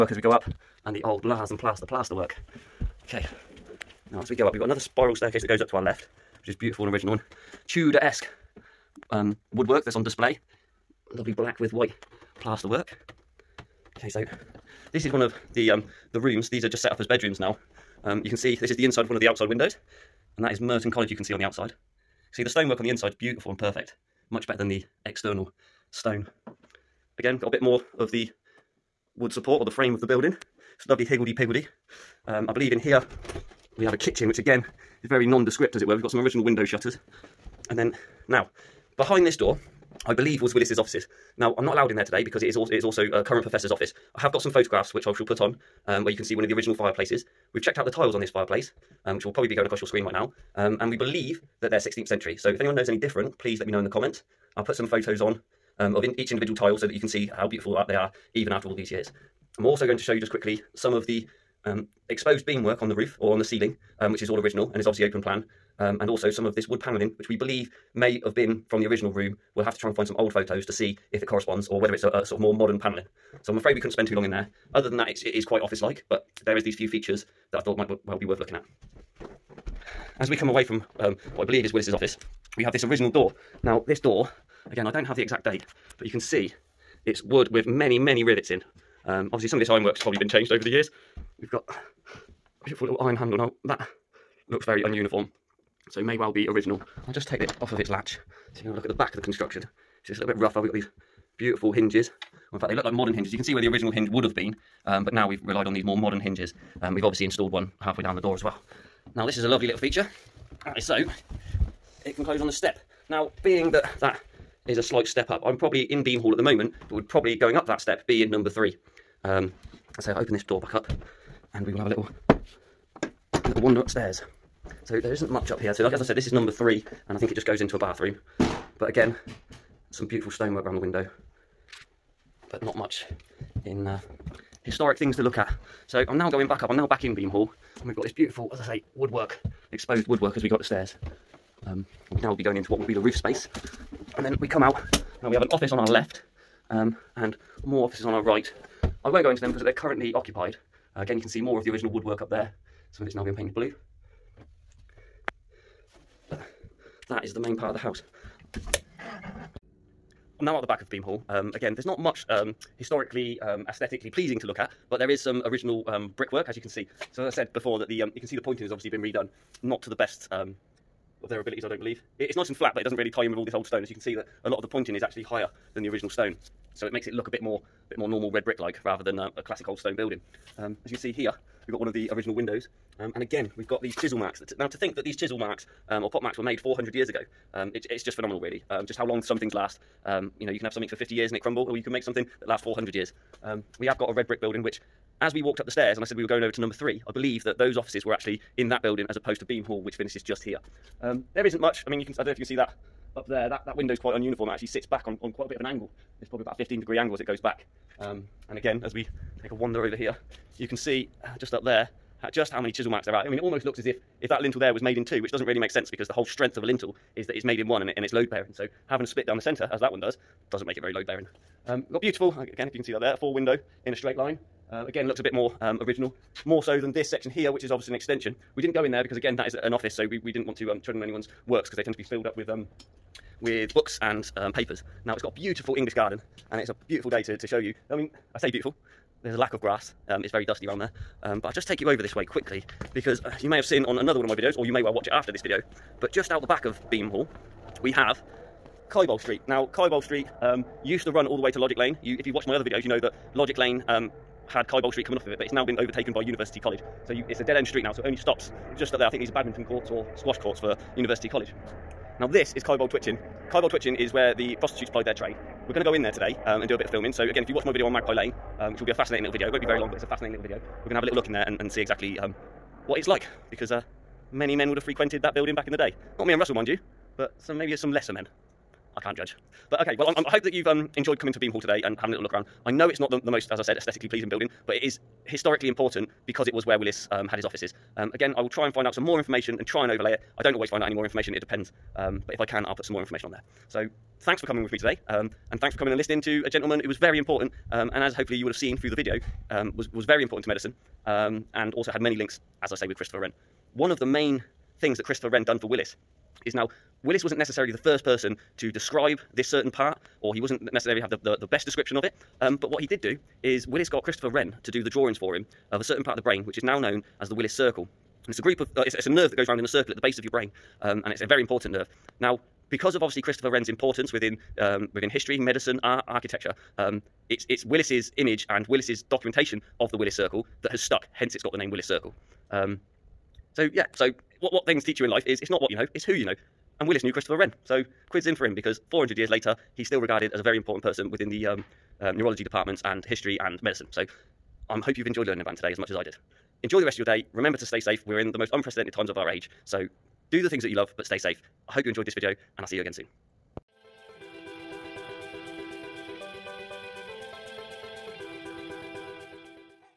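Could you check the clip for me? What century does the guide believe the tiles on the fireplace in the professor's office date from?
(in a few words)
16th century.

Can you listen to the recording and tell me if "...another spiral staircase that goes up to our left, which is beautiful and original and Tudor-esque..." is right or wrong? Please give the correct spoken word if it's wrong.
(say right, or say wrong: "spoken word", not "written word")
right.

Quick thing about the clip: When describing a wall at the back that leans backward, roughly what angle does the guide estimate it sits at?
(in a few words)
15 degrees.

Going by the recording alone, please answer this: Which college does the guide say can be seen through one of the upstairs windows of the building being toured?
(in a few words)
Merton College.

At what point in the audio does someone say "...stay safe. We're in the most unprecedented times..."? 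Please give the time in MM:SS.
05:47.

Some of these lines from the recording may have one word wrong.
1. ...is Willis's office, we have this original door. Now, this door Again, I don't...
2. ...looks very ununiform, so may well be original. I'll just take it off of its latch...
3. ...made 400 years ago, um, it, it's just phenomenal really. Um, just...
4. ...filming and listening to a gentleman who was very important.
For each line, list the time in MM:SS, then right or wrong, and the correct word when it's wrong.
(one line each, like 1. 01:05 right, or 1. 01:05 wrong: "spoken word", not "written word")
1. 01:21 right
2. 01:34 right
3. 03:06 right
4. 04:55 wrong: "coming", not "filming".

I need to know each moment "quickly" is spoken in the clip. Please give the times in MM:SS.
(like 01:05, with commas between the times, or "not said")
01:00, 04:02.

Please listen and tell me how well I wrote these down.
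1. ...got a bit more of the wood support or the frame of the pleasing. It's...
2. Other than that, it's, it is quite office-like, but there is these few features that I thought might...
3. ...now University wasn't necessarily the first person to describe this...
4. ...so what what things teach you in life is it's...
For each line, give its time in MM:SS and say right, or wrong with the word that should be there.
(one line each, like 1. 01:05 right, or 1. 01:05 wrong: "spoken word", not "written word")
1. 00:27 wrong: "building", not "pleasing"
2. 01:14 right
3. 05:06 wrong: "Willis", not "University"
4. 05:33 right.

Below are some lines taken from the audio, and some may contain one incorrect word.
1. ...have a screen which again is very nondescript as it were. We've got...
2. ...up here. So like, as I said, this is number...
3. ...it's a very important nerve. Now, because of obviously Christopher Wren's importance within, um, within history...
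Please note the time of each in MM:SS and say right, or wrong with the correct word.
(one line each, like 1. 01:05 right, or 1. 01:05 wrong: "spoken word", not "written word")
1. 00:33 wrong: "kitchen", not "screen"
2. 02:05 right
3. 05:21 right.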